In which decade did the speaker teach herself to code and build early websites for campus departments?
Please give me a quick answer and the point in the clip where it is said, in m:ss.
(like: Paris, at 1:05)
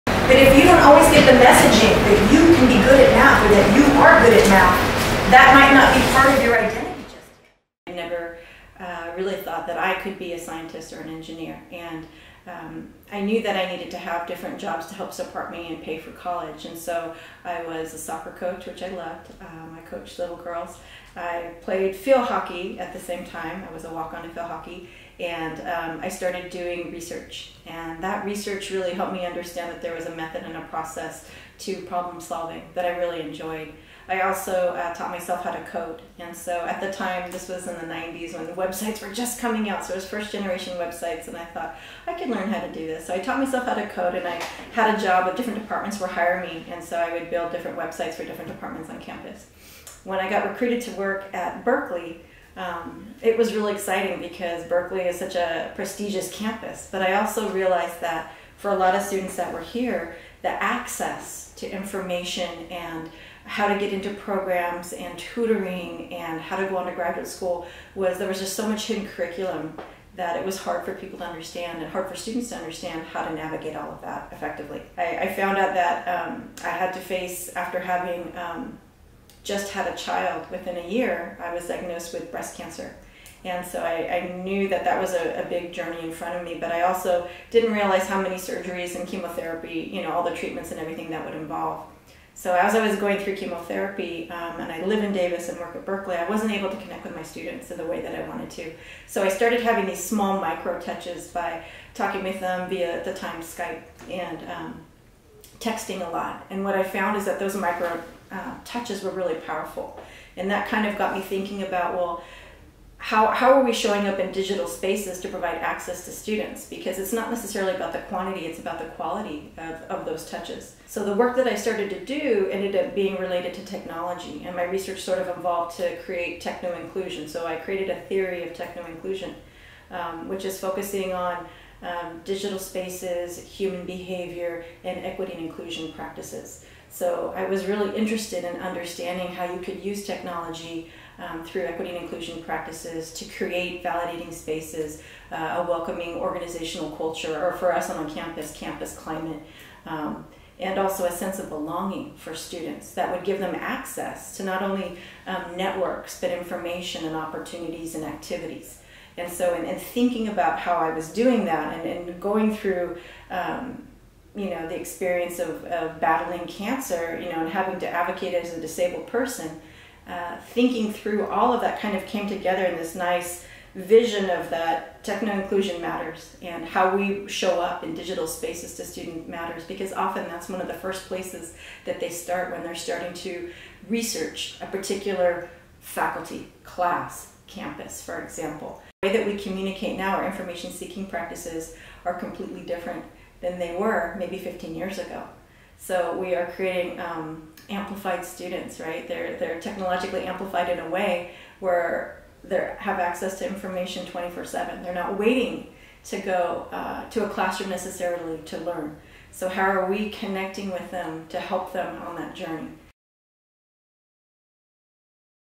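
the 90s, at 0:37.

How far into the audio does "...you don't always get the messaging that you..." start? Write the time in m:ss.
0:00.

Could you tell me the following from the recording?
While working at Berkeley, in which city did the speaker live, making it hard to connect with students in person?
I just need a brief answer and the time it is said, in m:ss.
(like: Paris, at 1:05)
Davis, at 1:35.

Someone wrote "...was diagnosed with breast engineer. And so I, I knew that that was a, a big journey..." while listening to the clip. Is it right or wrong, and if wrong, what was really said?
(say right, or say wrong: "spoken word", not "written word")
wrong: "cancer", not "engineer".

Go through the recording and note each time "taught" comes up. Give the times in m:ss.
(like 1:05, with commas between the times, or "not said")
0:34, 0:43.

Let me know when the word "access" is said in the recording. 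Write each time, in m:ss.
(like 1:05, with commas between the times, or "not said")
1:00, 1:55, 2:33, 3:22.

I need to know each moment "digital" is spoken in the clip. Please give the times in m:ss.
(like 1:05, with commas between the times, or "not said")
1:54, 2:12, 2:57.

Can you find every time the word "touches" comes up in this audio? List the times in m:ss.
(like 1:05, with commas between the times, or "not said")
1:40, 1:48, 2:00.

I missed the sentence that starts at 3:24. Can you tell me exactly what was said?
They're not waiting to go uh, to a classroom necessarily to learn.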